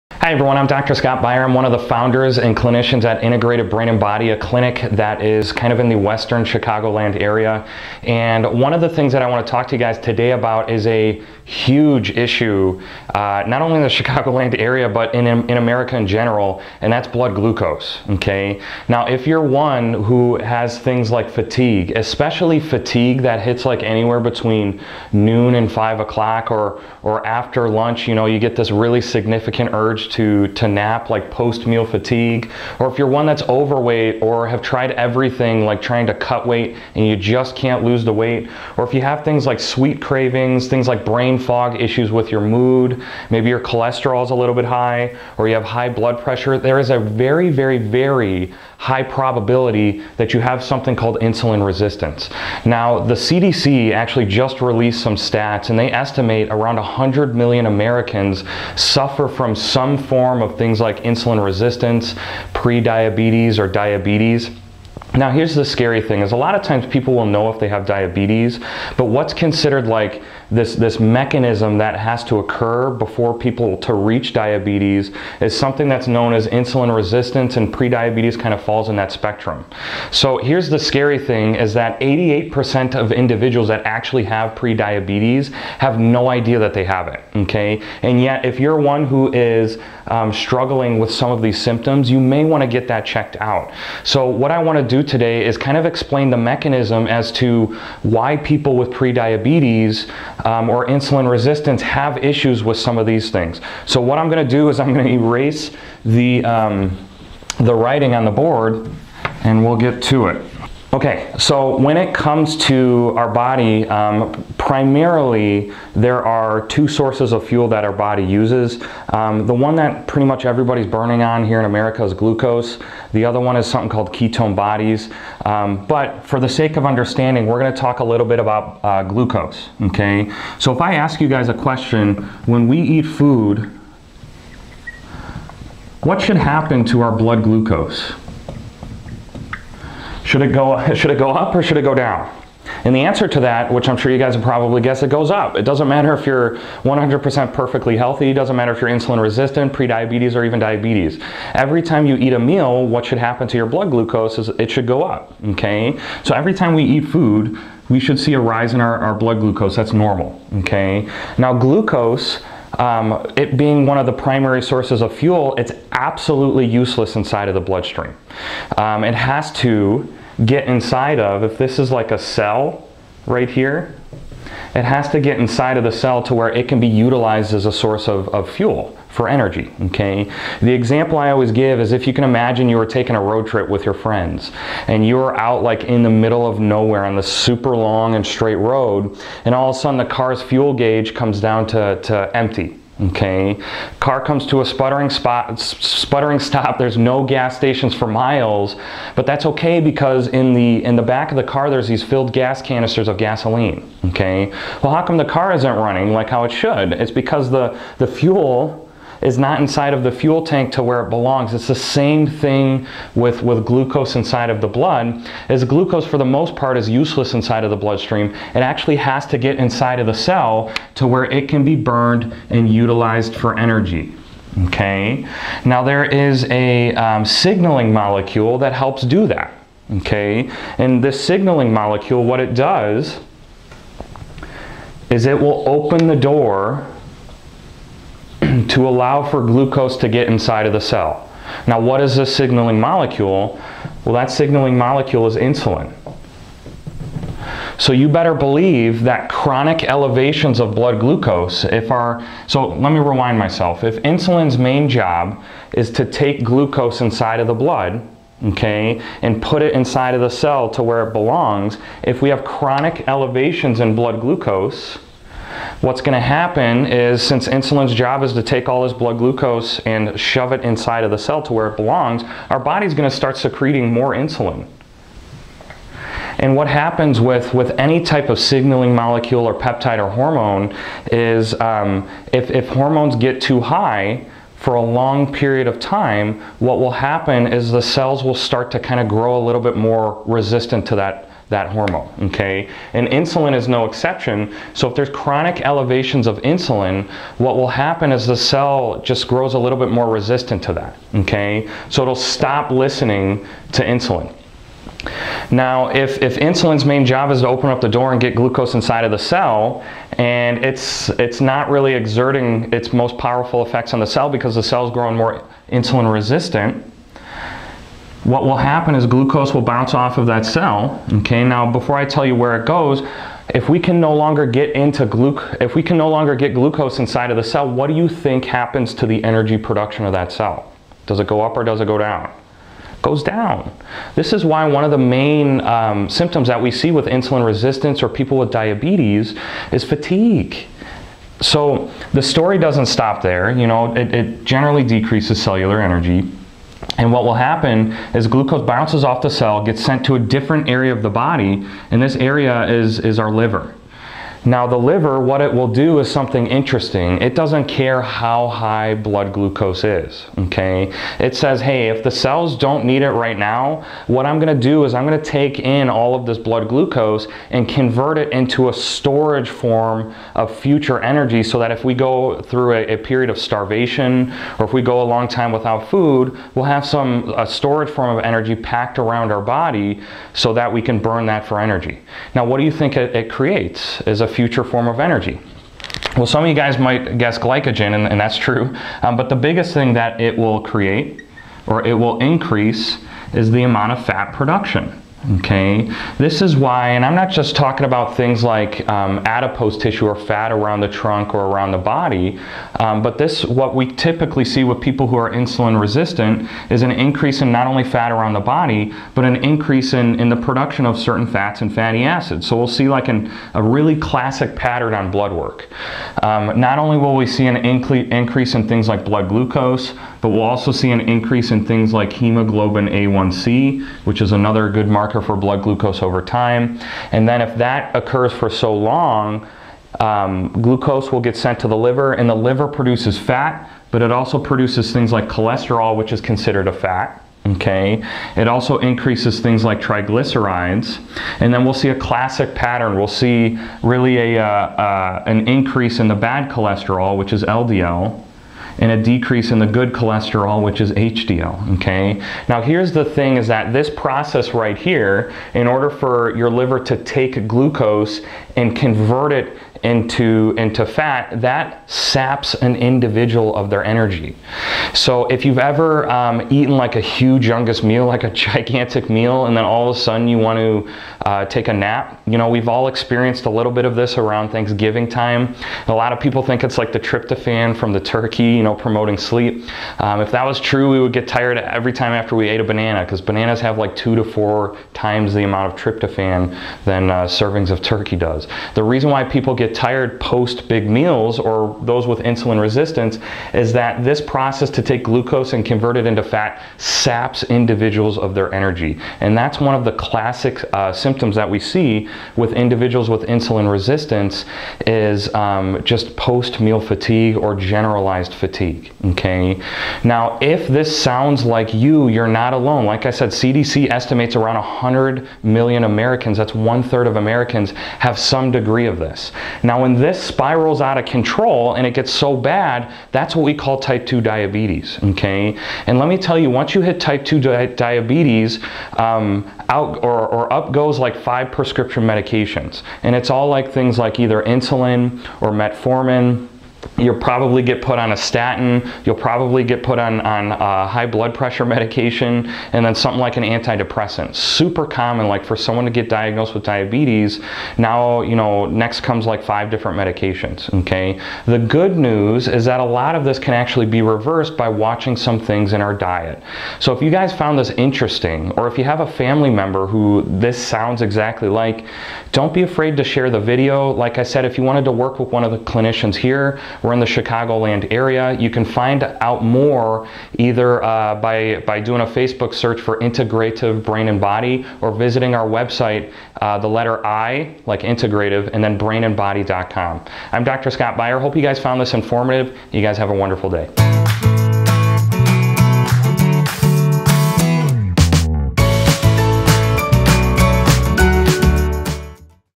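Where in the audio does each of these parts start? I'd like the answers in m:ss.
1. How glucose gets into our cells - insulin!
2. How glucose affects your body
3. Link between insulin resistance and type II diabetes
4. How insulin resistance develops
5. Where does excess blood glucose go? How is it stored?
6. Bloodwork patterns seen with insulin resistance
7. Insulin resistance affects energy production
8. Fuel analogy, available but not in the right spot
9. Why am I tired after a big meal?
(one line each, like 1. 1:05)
1. 3:45
2. 1:50
3. 8:29
4. 4:14
5. 5:41
6. 6:42
7. 4:54
8. 3:00
9. 7:32.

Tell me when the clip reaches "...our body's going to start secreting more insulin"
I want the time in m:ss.
4:32.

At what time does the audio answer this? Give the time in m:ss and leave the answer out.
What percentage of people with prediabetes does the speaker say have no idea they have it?
1:22.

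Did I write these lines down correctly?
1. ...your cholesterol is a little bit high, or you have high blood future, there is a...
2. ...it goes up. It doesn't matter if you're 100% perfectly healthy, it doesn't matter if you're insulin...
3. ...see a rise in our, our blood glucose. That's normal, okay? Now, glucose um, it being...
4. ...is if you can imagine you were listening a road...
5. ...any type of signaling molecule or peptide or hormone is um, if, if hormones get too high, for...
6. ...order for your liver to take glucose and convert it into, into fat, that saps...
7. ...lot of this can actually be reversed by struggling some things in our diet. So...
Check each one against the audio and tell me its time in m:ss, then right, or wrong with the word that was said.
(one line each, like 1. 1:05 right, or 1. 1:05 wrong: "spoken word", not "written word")
1. 0:43 wrong: "pressure", not "future"
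2. 2:25 right
3. 2:38 right
4. 3:01 wrong: "taking", not "listening"
5. 4:37 right
6. 7:35 right
7. 9:12 wrong: "watching", not "struggling".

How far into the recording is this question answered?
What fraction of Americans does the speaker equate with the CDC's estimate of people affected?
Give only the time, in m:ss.
8:36.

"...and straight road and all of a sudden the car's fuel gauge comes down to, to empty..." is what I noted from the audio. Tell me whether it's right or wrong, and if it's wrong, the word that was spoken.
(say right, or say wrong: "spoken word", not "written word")
right.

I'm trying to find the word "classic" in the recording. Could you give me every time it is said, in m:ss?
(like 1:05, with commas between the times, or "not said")
6:53, 7:21, 8:19.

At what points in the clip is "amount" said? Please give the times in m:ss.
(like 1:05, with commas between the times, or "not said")
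6:33, 8:05.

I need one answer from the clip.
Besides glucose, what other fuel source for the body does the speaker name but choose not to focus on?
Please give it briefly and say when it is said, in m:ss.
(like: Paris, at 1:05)
ketone bodies, at 2:04.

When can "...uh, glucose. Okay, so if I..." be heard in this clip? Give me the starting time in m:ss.
2:08.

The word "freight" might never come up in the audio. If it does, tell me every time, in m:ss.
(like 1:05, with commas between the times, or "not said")
not said.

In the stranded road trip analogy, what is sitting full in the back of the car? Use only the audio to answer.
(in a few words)
gas canisters.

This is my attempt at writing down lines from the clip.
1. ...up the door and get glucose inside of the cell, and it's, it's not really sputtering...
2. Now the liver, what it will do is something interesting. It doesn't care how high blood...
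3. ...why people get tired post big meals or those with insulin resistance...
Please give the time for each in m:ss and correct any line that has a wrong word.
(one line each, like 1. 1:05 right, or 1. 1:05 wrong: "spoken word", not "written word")
1. 5:07 wrong: "exerting", not "sputtering"
2. 5:54 right
3. 8:09 right.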